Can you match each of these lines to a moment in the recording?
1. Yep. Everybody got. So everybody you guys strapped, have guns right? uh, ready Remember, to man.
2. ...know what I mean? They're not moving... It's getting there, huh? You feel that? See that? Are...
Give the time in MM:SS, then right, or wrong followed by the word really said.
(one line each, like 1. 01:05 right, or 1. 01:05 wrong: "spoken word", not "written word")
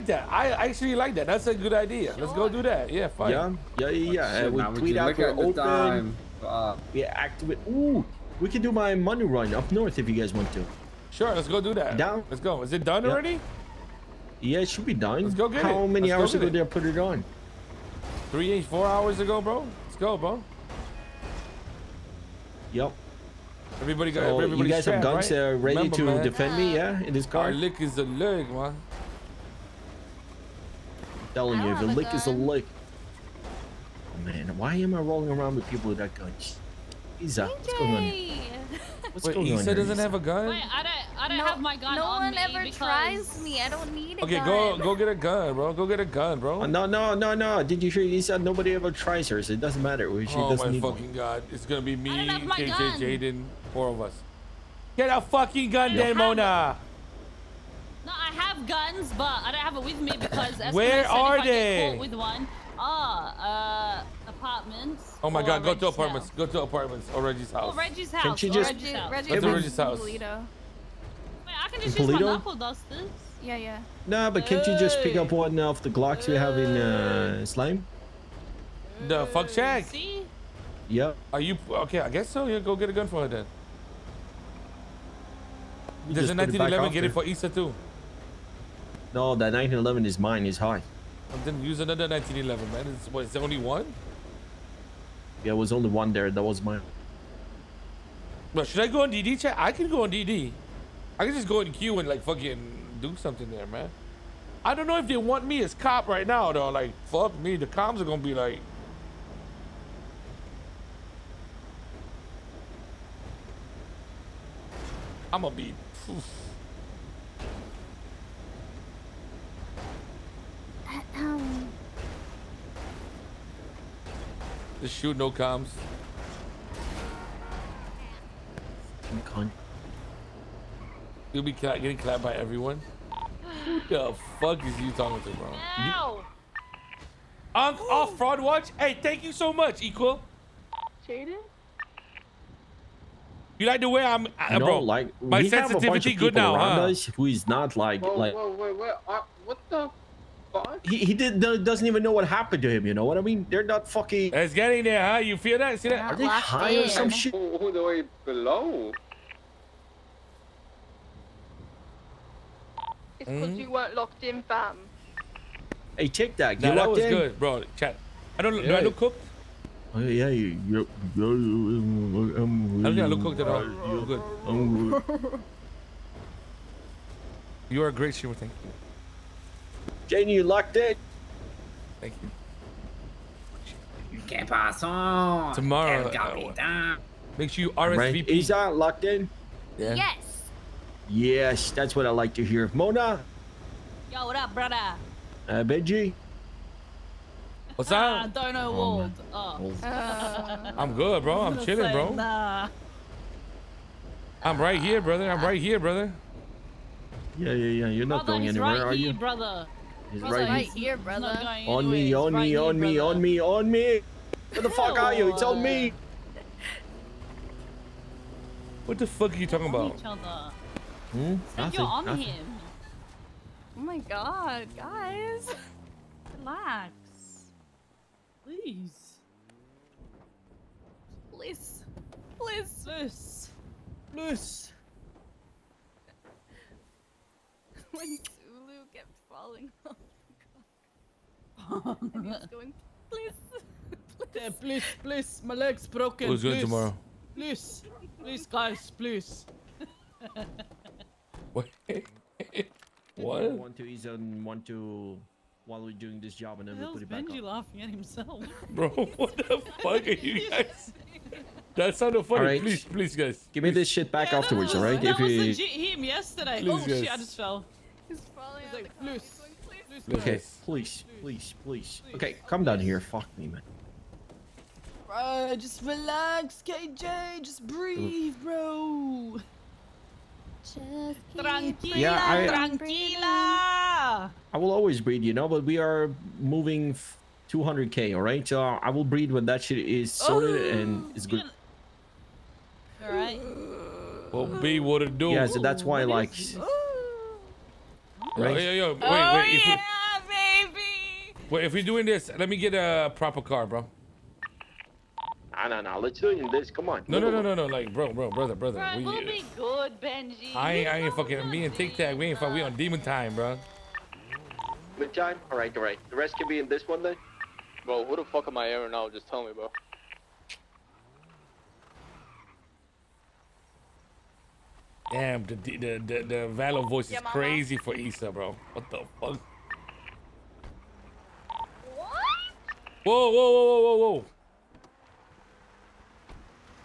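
1. 00:22 right
2. 02:32 wrong: "fucking", not "moving".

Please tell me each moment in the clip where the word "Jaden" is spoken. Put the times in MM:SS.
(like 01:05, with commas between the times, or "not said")
00:53, 02:21.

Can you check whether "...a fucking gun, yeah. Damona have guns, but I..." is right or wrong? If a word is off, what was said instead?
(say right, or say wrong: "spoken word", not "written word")
right.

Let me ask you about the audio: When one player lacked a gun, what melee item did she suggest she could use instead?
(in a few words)
Knuckle dusters.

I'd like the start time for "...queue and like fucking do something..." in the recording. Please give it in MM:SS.
01:41.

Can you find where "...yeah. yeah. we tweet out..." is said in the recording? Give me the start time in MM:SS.
00:04.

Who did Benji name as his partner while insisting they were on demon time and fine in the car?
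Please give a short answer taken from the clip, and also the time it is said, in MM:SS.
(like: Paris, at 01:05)
Tic Tac, at 05:11.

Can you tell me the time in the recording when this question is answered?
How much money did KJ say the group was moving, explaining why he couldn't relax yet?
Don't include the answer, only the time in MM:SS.
04:47.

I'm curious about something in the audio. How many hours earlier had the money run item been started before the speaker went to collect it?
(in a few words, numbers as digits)
4.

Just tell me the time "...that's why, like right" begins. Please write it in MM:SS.
04:55.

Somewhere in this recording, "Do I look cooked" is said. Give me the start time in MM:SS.
02:48.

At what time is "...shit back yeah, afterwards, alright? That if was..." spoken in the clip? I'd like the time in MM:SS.
04:23.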